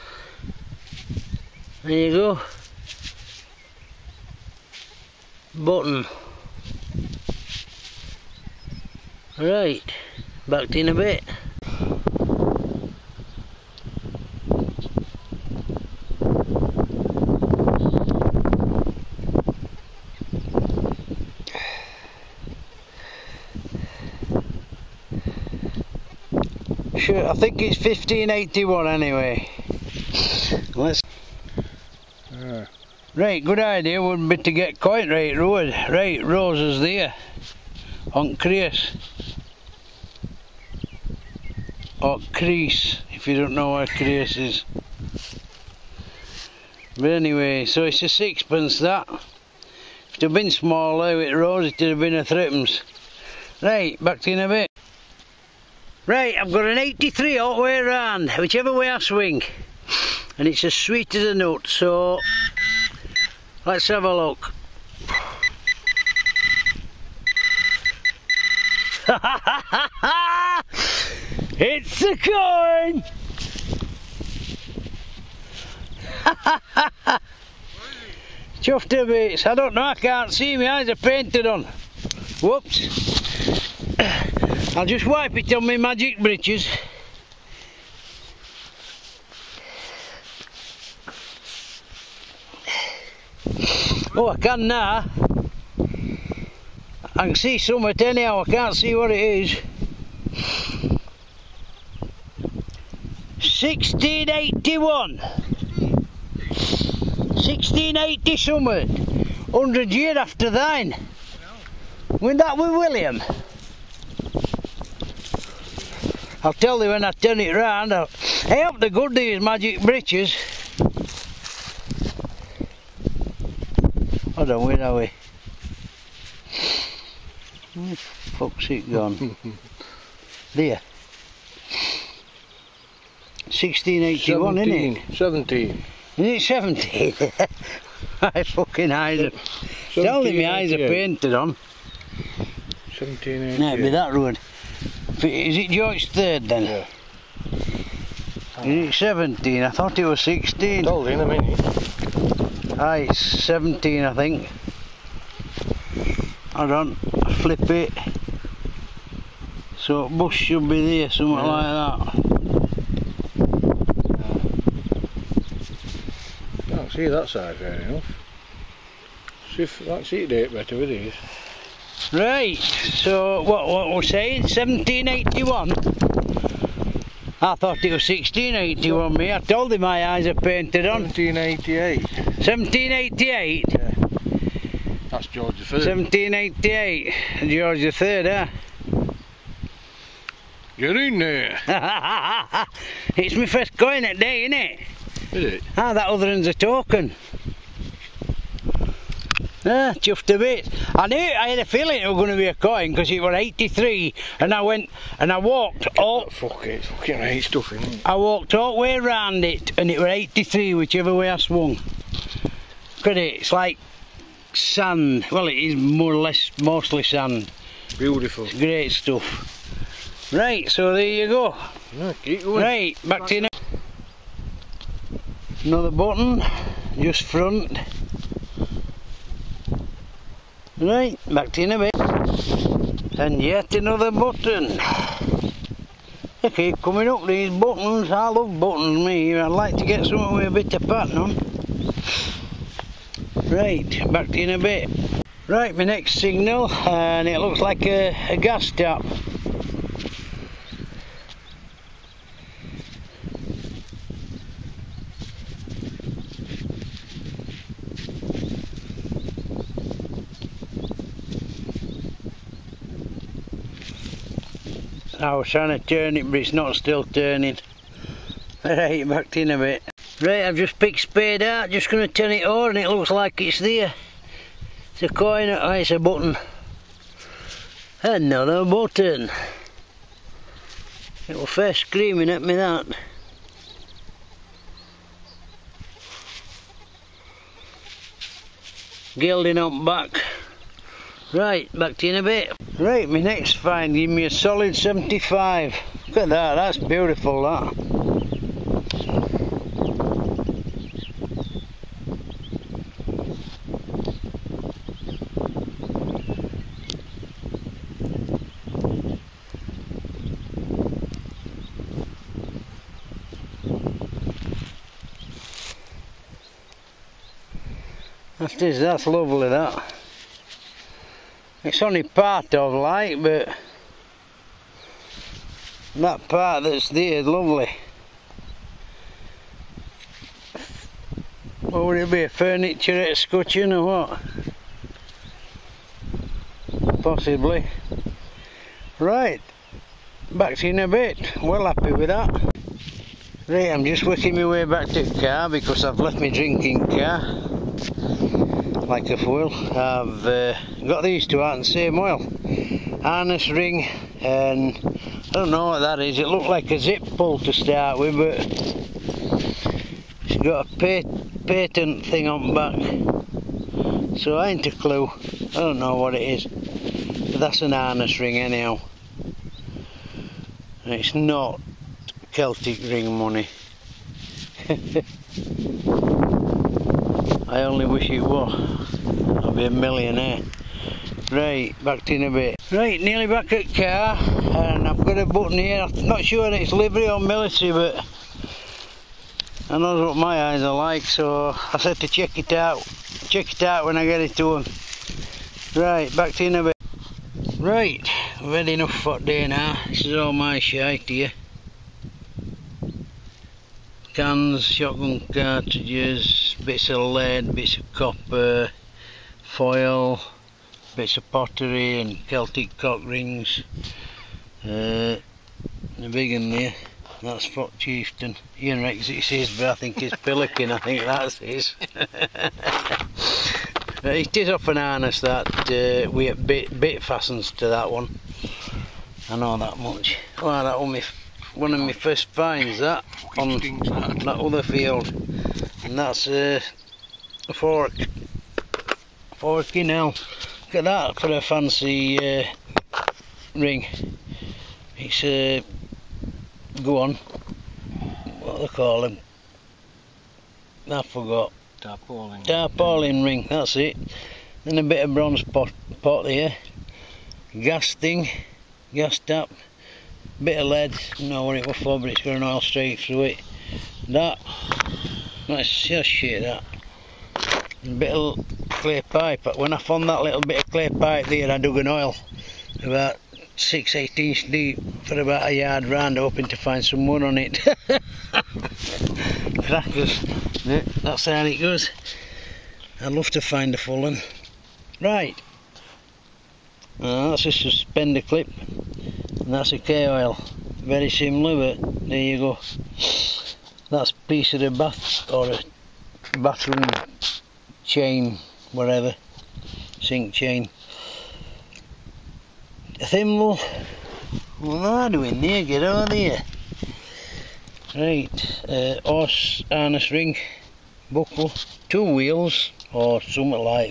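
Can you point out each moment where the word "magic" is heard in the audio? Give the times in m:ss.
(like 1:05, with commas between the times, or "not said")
1:25, 1:59.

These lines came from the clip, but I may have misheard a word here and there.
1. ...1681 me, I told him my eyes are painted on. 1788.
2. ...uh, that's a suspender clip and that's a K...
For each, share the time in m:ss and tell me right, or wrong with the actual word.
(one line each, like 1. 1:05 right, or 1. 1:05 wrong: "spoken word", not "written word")
1. 2:58 right
2. 8:07 right.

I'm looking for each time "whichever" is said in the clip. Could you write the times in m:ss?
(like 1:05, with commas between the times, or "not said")
0:58, 3:30.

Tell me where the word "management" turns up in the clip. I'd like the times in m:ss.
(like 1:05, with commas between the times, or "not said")
not said.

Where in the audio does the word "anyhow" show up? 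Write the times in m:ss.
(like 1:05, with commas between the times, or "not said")
1:38, 6:08.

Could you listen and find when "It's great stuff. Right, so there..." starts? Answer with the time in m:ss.
3:38.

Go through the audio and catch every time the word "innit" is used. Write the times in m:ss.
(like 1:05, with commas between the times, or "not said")
3:14.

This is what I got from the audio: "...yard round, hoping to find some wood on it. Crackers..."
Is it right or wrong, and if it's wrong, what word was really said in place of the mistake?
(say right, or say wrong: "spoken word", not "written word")
right.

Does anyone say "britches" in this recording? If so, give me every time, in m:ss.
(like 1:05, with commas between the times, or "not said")
1:26.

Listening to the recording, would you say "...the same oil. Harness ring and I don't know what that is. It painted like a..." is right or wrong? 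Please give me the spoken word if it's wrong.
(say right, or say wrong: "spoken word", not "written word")
wrong: "looked", not "painted".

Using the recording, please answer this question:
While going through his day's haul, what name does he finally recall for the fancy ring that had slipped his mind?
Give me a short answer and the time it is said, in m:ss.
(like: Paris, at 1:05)
tarpaulin ring, at 7:32.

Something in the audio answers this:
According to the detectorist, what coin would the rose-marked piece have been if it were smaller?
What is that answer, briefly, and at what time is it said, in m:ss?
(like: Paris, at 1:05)
threepence, at 0:52.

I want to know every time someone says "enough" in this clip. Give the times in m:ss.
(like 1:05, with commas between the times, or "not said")
2:47, 6:38.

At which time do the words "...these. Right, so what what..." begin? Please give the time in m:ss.
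2:50.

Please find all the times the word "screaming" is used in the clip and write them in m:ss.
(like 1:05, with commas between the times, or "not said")
4:41.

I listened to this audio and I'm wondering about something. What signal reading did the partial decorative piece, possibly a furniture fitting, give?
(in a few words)
75.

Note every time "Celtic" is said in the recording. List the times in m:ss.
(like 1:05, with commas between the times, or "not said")
6:12, 6:52.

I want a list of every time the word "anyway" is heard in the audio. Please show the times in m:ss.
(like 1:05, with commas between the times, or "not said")
0:28, 0:47.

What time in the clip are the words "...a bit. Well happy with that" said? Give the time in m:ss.
5:40.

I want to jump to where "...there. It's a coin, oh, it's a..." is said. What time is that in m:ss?
4:33.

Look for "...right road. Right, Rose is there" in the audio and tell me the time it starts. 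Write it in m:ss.
0:35.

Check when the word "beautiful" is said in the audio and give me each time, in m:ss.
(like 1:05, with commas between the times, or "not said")
3:37, 4:56.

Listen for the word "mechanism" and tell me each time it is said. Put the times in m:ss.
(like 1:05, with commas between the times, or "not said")
not said.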